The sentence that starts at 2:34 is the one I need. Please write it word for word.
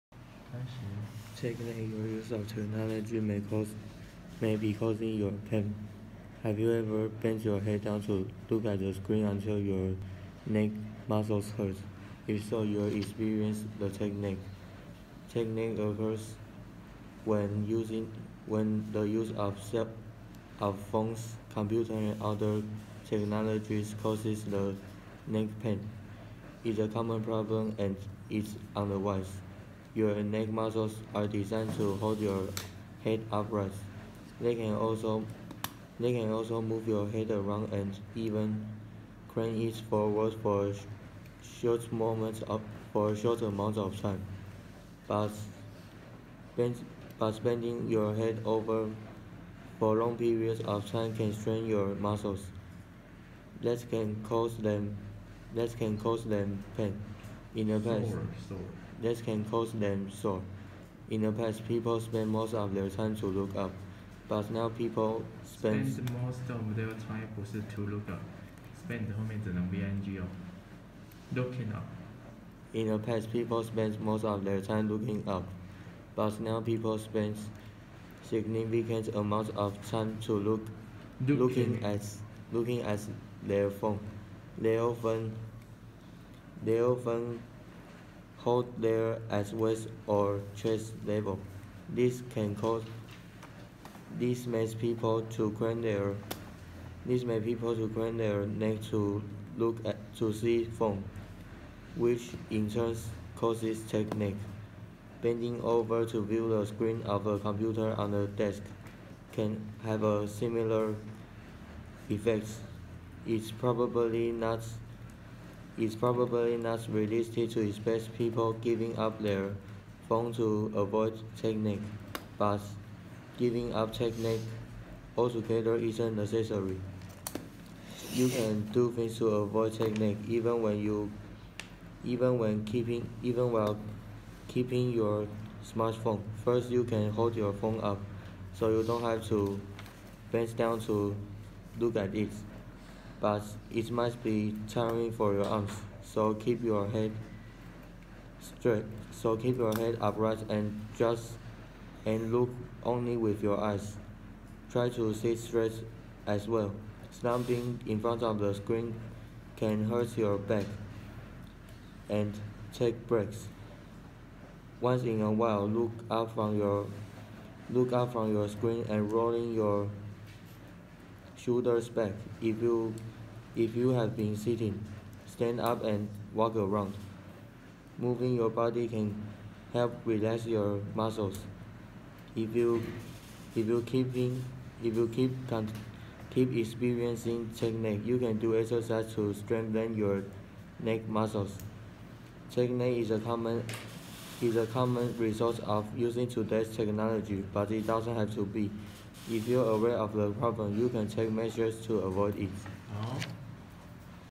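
Try to sit straight as well.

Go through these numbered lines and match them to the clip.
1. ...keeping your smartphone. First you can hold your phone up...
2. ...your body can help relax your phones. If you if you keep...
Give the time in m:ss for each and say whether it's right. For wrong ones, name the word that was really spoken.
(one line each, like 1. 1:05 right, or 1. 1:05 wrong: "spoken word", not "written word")
1. 2:14 right
2. 2:58 wrong: "muscles", not "phones".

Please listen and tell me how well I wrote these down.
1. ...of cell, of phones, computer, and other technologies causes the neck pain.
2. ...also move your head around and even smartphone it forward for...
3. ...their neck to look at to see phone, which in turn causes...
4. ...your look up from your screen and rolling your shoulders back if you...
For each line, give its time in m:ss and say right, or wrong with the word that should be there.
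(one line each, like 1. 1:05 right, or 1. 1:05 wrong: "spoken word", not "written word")
1. 0:19 right
2. 0:36 wrong: "crane", not "smartphone"
3. 1:38 right
4. 2:46 right.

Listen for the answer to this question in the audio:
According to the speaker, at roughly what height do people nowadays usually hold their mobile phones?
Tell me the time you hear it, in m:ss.
1:29.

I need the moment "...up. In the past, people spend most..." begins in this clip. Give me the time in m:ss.
1:11.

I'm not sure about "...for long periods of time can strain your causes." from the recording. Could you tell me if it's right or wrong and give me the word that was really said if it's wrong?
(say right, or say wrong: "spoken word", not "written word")
wrong: "muscles", not "causes".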